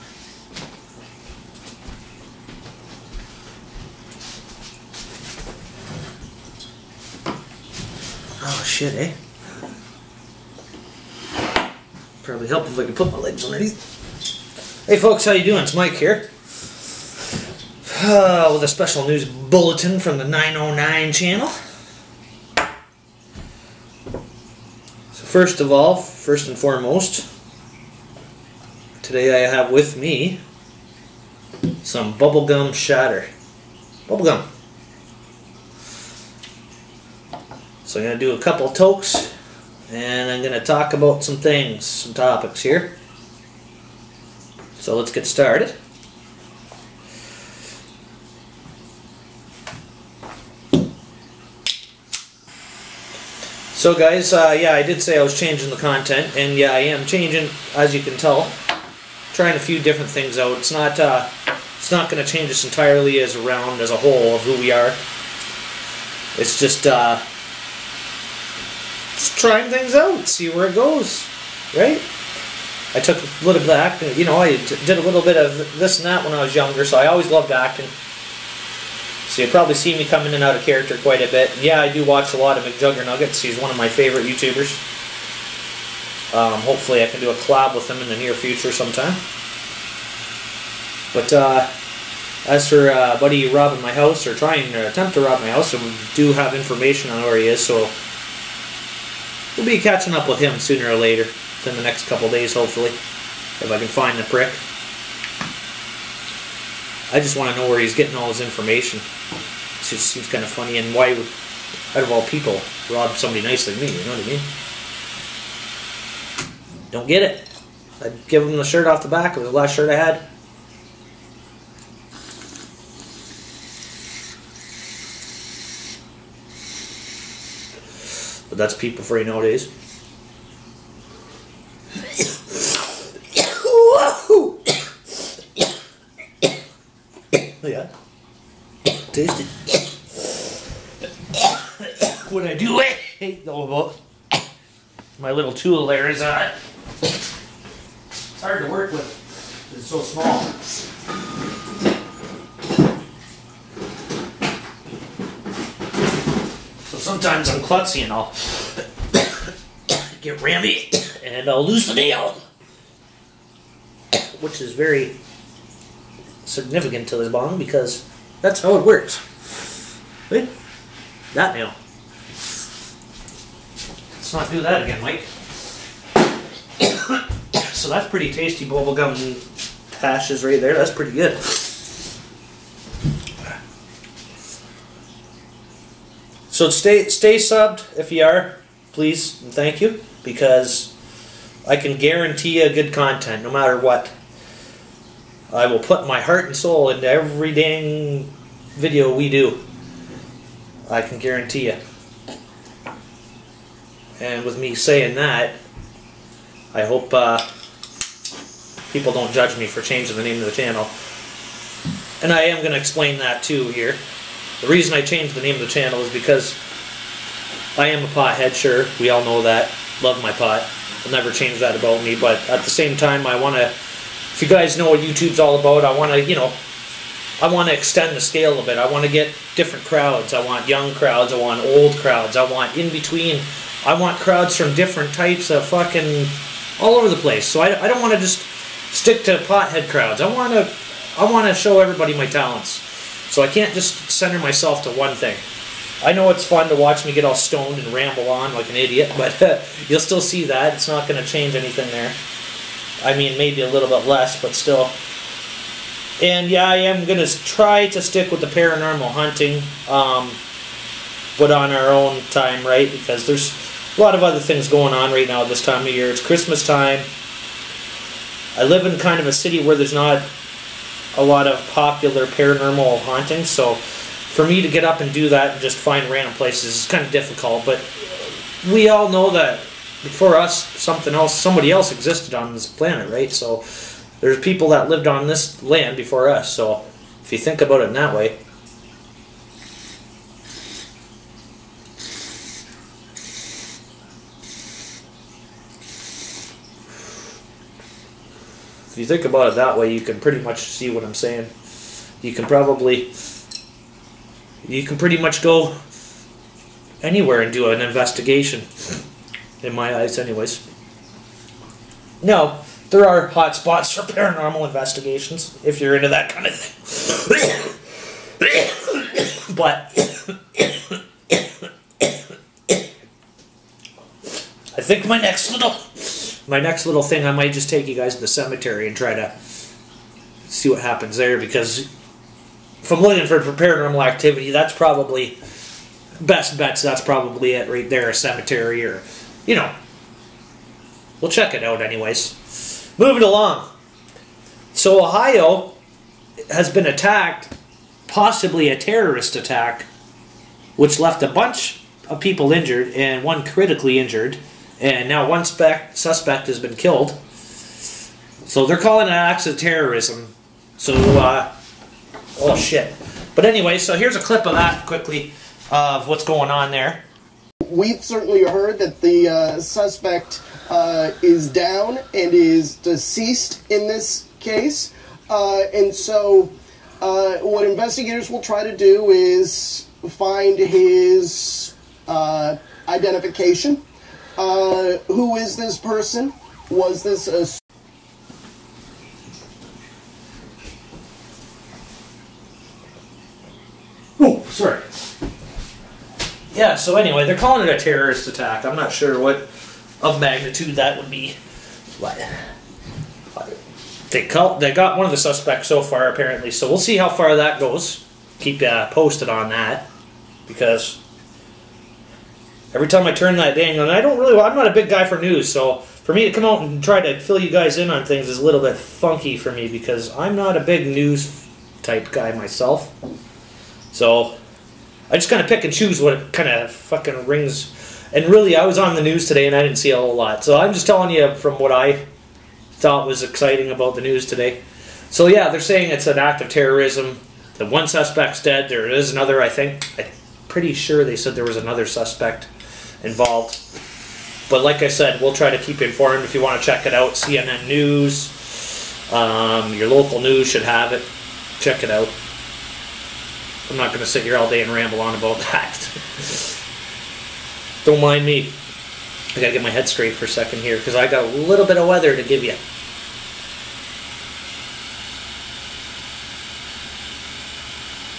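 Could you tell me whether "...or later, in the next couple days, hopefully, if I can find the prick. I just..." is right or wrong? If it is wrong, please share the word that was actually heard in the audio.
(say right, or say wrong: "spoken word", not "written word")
right.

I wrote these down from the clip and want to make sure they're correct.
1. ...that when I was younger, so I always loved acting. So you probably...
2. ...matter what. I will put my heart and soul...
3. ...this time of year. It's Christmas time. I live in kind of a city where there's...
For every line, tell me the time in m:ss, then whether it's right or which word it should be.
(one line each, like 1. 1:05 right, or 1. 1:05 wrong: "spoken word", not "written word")
1. 1:16 right
2. 3:13 right
3. 4:25 right.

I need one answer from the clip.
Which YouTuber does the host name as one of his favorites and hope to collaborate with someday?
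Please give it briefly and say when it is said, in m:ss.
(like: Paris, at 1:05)
McJuggerNuggets, at 1:22.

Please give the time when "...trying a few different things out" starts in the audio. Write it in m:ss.
0:59.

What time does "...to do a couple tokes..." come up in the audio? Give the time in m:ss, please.
0:38.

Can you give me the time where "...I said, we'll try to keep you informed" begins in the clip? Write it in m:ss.
7:24.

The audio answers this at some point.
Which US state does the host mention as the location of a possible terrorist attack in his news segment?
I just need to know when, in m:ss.
5:45.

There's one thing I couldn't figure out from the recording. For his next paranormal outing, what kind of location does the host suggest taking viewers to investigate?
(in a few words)
A cemetery.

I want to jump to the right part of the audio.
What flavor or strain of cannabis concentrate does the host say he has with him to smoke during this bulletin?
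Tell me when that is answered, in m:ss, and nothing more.
0:32.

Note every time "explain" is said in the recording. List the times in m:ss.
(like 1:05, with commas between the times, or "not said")
3:32.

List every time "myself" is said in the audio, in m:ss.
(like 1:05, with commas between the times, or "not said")
4:04, 7:02.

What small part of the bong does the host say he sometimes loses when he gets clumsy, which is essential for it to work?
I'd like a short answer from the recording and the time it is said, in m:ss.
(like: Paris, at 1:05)
The nail, at 2:41.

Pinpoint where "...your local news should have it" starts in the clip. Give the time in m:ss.
7:29.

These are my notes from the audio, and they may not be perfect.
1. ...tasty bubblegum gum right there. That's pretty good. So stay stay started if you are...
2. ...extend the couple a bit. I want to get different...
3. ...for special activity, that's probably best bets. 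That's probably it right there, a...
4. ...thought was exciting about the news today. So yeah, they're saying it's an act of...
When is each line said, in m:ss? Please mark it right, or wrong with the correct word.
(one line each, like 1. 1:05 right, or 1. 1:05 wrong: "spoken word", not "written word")
1. 2:58 wrong: "subbed", not "started"
2. 3:47 wrong: "scale", not "couple"
3. 5:33 wrong: "paranormal", not "special"
4. 7:12 right.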